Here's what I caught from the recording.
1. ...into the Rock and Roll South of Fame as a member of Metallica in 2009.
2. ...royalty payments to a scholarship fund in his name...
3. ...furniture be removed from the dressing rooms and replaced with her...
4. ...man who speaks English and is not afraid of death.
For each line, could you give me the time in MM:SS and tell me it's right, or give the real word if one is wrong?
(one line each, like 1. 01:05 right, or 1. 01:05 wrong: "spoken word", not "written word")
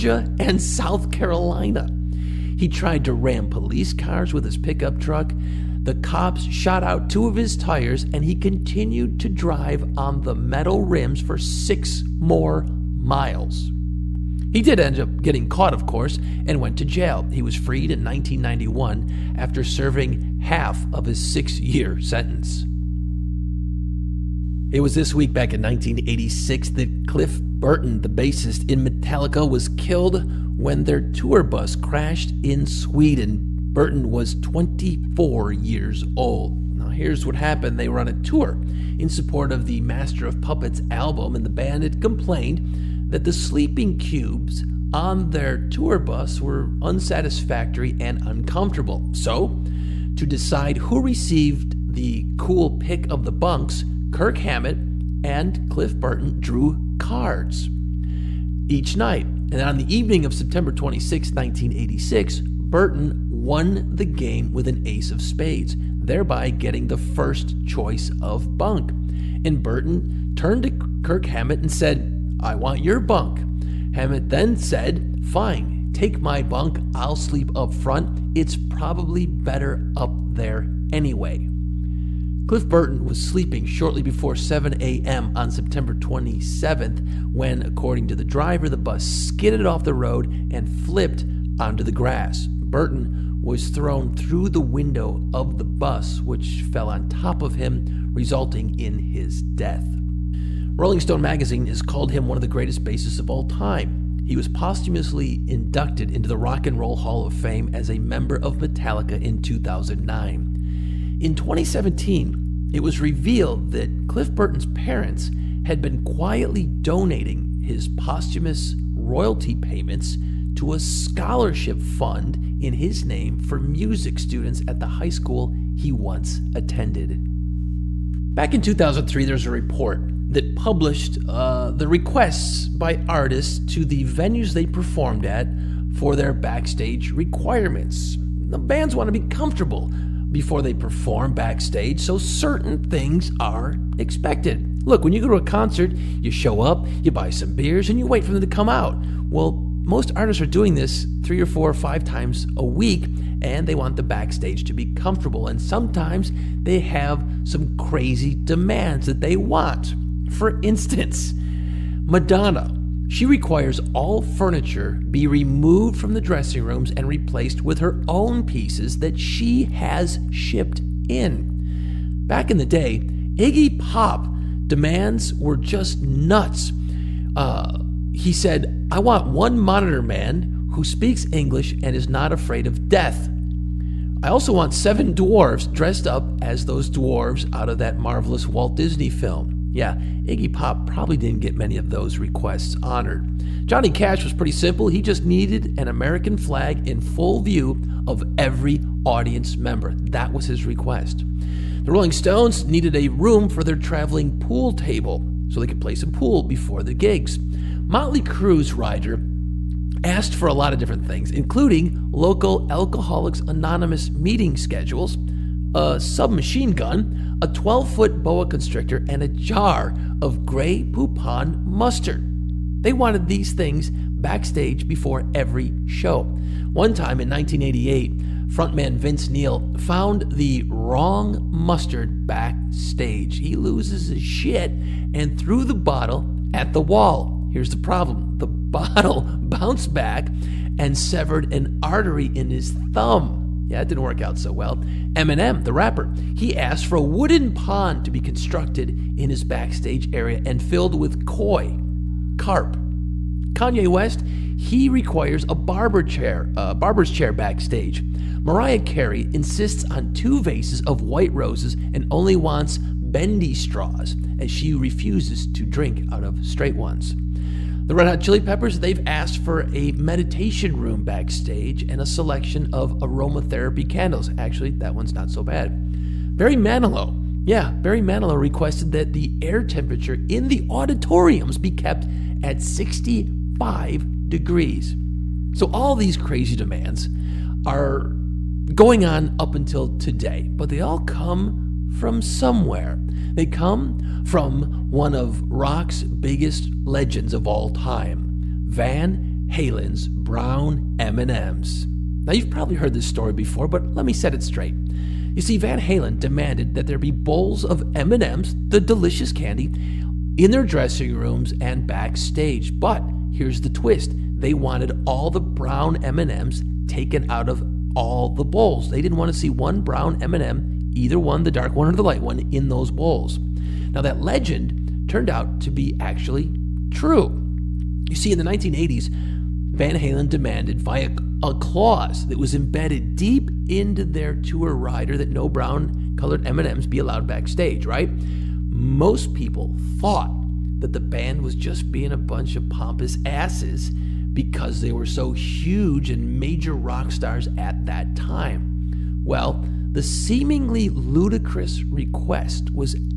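1. 01:46 wrong: "Hall", not "South"
2. 01:58 right
3. 02:44 right
4. 03:00 right.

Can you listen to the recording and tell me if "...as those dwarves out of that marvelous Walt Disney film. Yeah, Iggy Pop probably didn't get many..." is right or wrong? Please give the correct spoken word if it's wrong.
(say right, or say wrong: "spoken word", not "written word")
right.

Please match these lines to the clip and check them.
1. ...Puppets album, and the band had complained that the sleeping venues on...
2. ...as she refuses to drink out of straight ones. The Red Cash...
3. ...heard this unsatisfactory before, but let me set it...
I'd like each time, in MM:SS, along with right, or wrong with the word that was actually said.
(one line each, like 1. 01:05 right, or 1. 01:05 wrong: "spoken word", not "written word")
1. 00:40 wrong: "cubes", not "venues"
2. 04:24 wrong: "Hot", not "Cash"
3. 05:02 wrong: "story", not "unsatisfactory".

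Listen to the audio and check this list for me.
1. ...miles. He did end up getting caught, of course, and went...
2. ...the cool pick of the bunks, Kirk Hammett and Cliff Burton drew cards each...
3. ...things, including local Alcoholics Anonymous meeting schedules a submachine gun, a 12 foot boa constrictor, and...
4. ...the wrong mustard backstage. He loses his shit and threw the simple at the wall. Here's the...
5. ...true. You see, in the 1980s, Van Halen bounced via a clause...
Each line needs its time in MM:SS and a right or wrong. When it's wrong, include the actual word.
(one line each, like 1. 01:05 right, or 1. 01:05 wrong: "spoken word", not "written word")
1. 00:12 right
2. 00:51 right
3. 03:31 right
4. 03:50 wrong: "bottle", not "simple"
5. 05:26 wrong: "demanded", not "bounced".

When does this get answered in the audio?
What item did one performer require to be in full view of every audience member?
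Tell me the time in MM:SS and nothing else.
03:15.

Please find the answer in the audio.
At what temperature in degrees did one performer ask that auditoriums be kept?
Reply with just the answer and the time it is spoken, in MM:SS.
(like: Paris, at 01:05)
65, at 04:42.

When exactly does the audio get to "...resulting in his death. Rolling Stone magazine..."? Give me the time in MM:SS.
01:38.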